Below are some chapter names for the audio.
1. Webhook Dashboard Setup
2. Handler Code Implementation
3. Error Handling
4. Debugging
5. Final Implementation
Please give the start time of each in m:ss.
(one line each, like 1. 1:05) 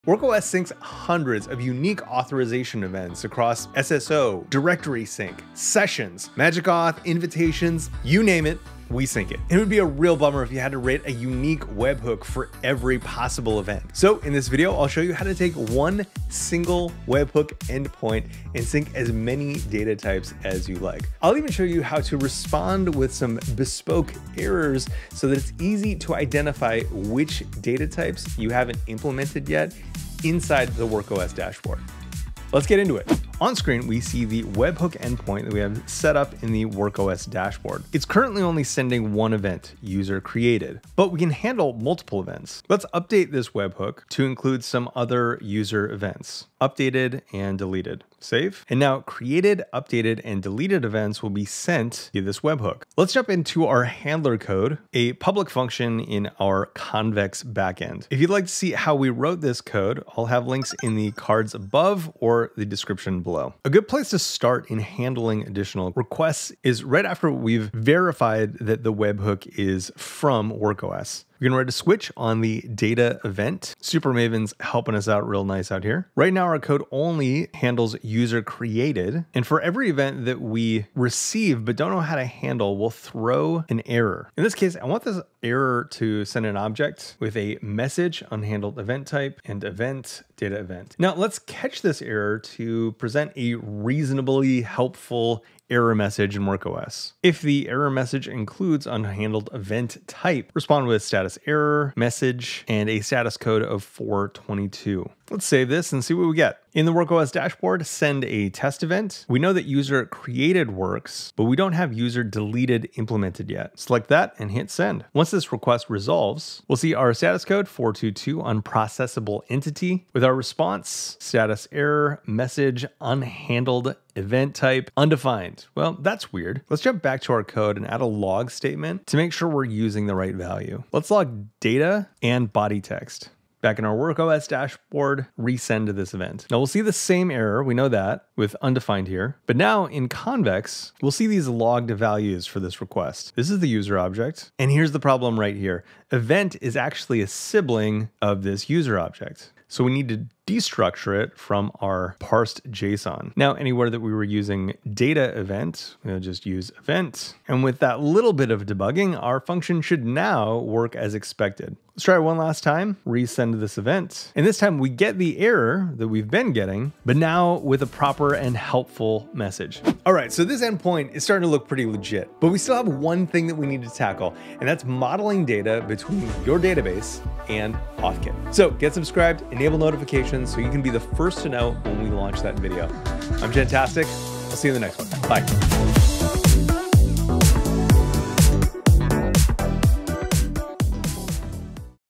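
1. 0:33
2. 0:52
3. 1:24
4. 1:55
5. 2:50.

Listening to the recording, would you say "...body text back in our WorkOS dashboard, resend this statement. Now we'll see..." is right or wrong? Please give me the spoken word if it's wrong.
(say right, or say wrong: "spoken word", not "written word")
wrong: "event", not "statement".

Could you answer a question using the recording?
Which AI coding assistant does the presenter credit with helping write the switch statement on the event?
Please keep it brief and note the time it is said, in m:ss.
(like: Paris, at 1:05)
Supermaven, at 1:13.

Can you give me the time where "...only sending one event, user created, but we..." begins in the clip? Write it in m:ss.
0:38.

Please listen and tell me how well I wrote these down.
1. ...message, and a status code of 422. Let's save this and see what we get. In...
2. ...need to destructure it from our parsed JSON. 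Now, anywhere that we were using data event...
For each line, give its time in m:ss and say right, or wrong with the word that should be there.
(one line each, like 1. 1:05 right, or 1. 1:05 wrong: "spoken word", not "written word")
1. 1:41 right
2. 2:29 right.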